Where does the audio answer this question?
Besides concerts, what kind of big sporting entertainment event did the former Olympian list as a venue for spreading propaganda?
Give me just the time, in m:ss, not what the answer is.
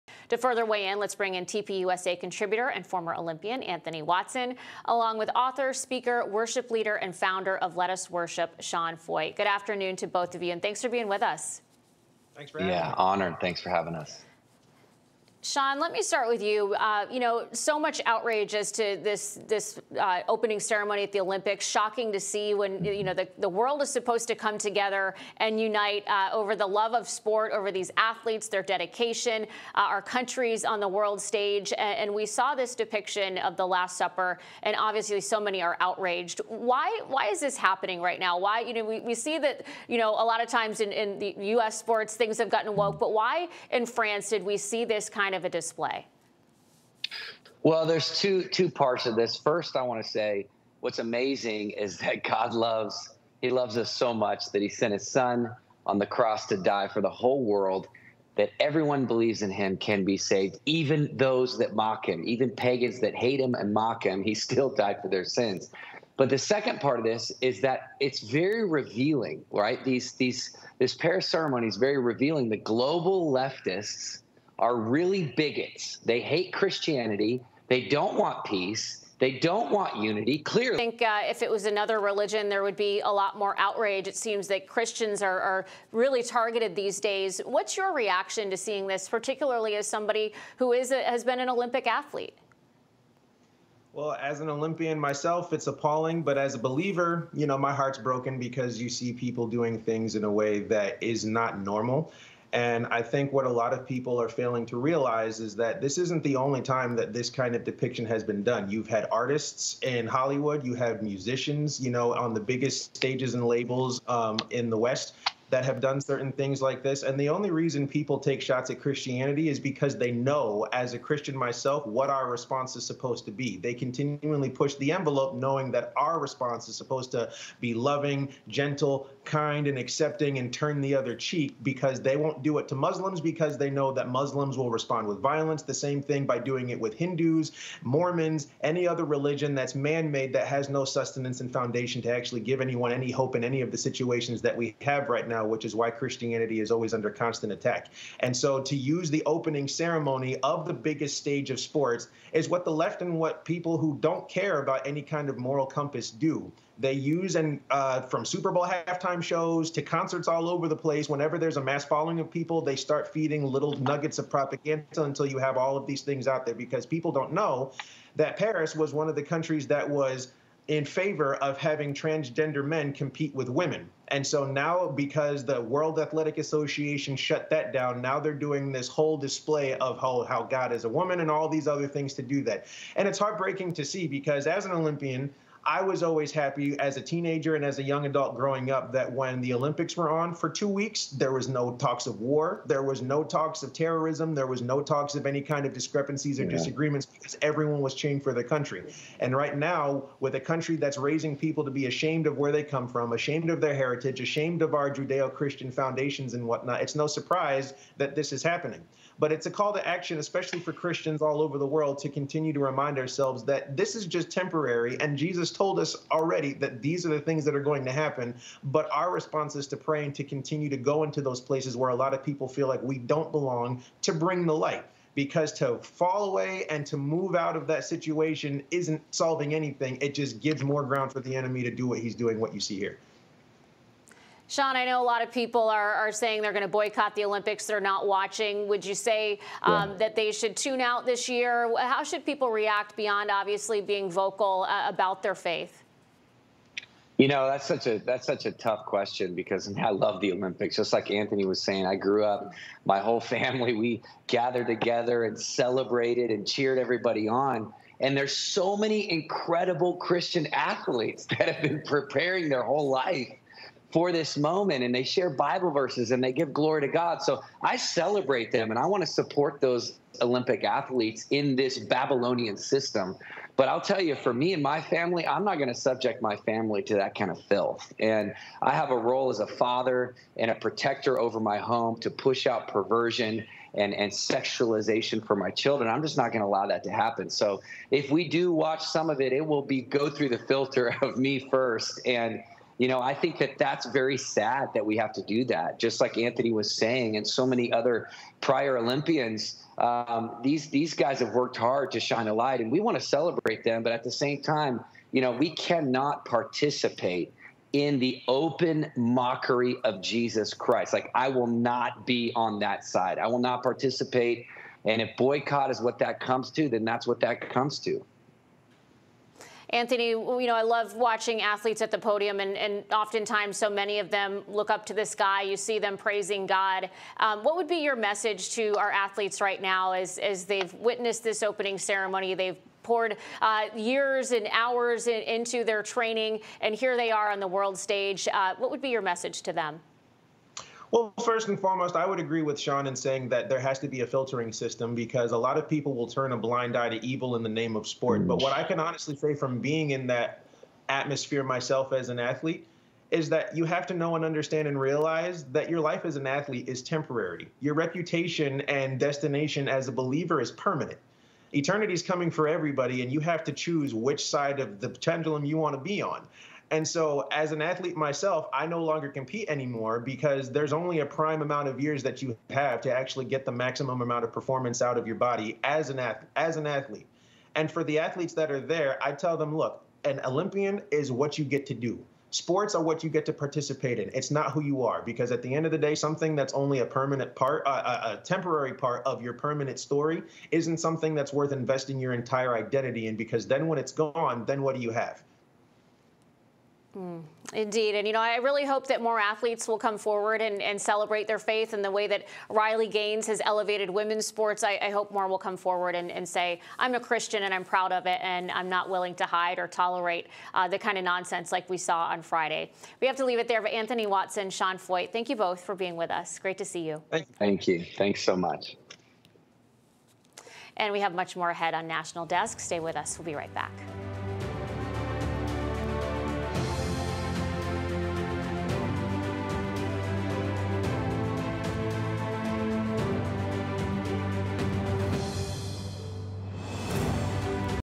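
2:38.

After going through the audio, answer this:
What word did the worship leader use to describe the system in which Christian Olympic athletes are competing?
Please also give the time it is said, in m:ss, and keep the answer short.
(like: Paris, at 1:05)
Babylonian, at 4:31.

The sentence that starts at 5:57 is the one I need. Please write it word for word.
Your reputation and destination as a believer is permanent.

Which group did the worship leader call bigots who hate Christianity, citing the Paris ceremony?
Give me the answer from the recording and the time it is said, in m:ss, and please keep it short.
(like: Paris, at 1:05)
The global leftists, at 1:12.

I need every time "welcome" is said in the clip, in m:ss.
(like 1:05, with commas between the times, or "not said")
not said.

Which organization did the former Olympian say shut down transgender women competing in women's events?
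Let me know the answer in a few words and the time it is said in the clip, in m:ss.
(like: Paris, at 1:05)
World Athletic Association, at 2:55.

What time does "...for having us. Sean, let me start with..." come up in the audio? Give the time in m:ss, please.
0:13.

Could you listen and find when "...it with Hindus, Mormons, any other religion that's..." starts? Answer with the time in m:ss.
2:16.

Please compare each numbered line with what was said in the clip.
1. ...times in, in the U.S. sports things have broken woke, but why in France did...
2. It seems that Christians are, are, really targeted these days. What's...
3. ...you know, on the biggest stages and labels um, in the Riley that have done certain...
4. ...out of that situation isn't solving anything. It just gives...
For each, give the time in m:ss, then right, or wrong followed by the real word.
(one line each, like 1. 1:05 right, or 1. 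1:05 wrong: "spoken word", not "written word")
1. 0:40 wrong: "gotten", not "broken"
2. 1:24 right
3. 1:51 wrong: "West", not "Riley"
4. 3:47 right.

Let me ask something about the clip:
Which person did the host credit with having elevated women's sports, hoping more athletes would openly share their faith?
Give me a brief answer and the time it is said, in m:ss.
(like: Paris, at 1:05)
Riley Gaines, at 6:42.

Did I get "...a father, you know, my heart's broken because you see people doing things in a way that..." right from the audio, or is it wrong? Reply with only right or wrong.
wrong.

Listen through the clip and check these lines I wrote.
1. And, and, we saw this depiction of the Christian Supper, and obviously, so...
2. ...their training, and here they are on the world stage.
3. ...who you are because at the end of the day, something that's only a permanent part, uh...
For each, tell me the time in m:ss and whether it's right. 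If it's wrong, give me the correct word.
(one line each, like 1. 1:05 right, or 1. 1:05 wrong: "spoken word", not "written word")
1. 0:31 wrong: "Last", not "Christian"
2. 5:35 right
3. 6:24 right.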